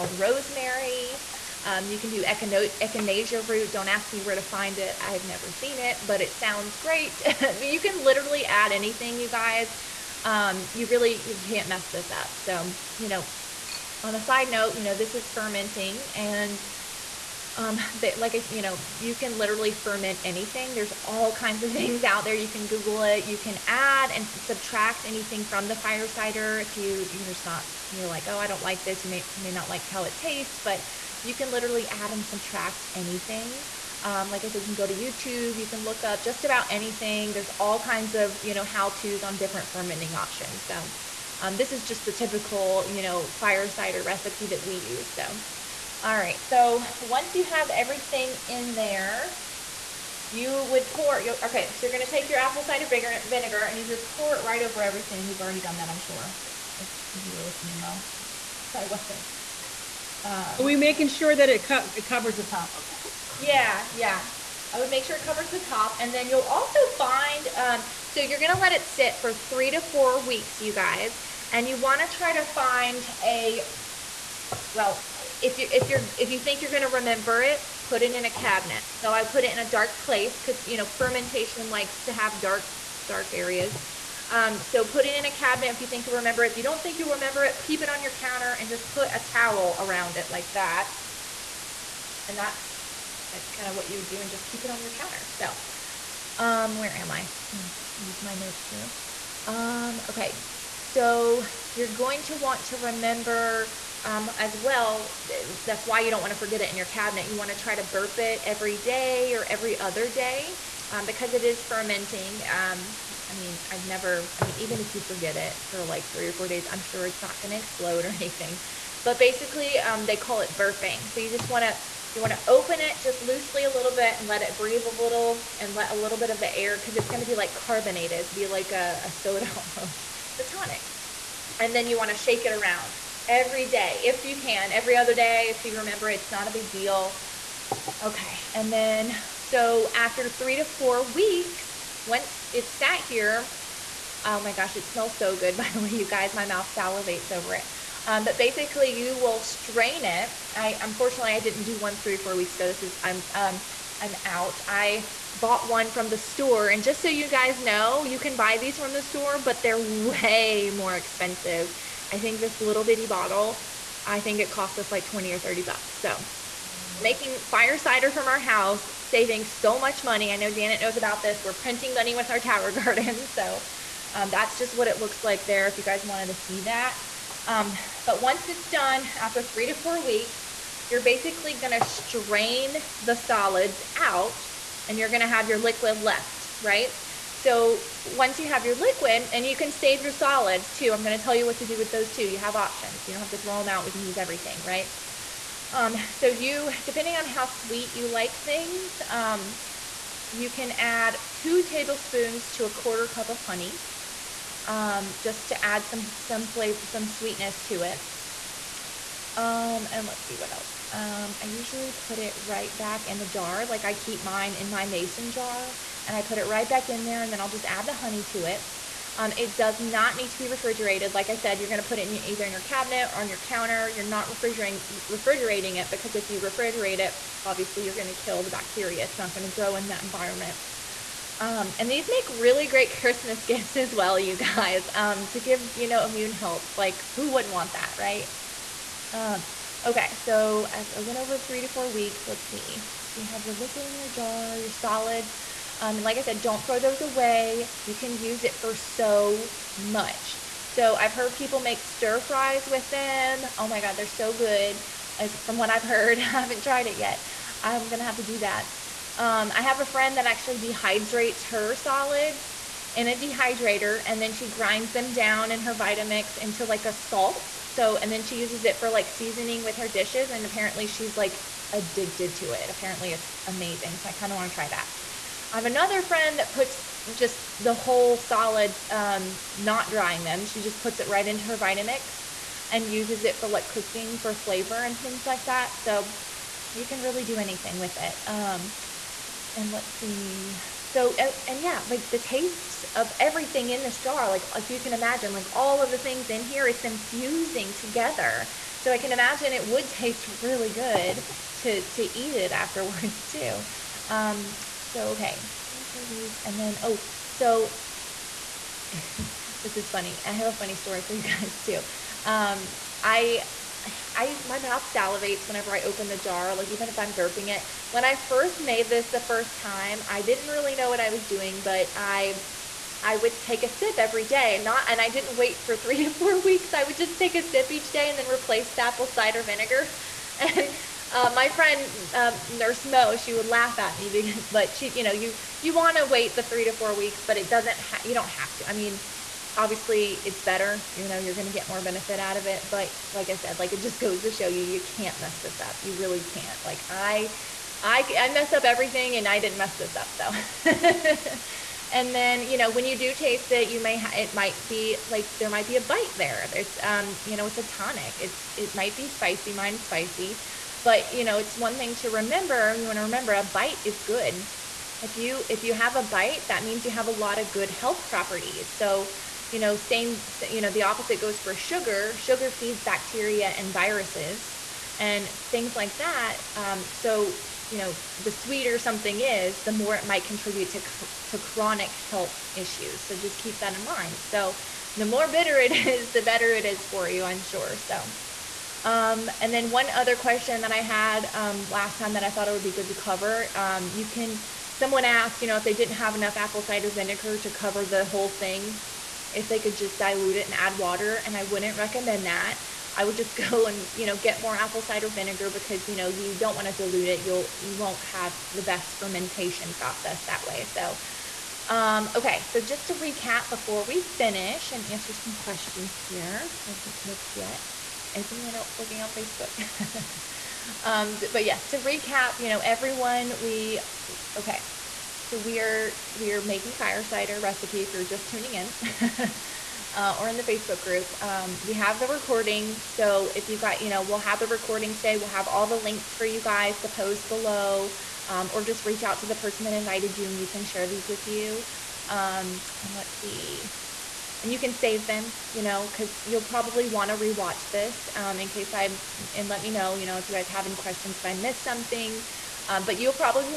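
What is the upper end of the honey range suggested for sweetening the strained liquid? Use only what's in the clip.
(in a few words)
a quarter cup.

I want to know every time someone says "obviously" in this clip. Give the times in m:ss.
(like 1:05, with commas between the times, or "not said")
3:47, 5:39.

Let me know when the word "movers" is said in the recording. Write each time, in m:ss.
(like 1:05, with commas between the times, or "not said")
not said.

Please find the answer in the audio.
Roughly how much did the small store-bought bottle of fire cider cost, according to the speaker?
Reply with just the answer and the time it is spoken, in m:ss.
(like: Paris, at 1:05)
20 or 30 bucks, at 2:45.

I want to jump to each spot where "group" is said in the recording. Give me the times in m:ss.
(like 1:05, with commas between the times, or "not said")
7:10.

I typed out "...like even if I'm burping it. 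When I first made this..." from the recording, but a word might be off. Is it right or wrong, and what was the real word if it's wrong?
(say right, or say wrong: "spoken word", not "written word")
right.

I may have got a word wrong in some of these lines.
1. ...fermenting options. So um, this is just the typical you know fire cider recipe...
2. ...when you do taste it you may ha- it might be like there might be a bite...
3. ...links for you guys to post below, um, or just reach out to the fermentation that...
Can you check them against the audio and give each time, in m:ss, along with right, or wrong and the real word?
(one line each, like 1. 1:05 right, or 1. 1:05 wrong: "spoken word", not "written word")
1. 0:39 right
2. 5:52 right
3. 7:15 wrong: "person", not "fermentation".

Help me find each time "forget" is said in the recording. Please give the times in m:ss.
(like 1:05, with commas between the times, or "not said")
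1:46, 1:55.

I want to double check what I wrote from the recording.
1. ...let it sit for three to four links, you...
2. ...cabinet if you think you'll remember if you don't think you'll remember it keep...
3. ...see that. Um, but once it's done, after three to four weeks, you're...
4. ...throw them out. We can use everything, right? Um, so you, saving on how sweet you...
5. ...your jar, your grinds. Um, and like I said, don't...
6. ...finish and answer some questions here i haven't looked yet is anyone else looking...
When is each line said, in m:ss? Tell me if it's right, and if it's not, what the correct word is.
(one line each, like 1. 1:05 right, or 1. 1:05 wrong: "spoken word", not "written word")
1. 1:08 wrong: "weeks", not "links"
2. 1:25 right
3. 2:56 right
4. 3:13 wrong: "depending", not "saving"
5. 4:03 wrong: "solids", not "grinds"
6. 6:54 right.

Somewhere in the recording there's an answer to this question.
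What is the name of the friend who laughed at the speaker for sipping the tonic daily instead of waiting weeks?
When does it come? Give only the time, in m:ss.
5:32.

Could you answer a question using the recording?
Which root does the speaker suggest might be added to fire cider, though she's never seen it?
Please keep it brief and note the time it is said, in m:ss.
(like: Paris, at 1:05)
echinacea root, at 0:02.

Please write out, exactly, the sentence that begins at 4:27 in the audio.
So, and then she uses it for like seasoning with her dishes.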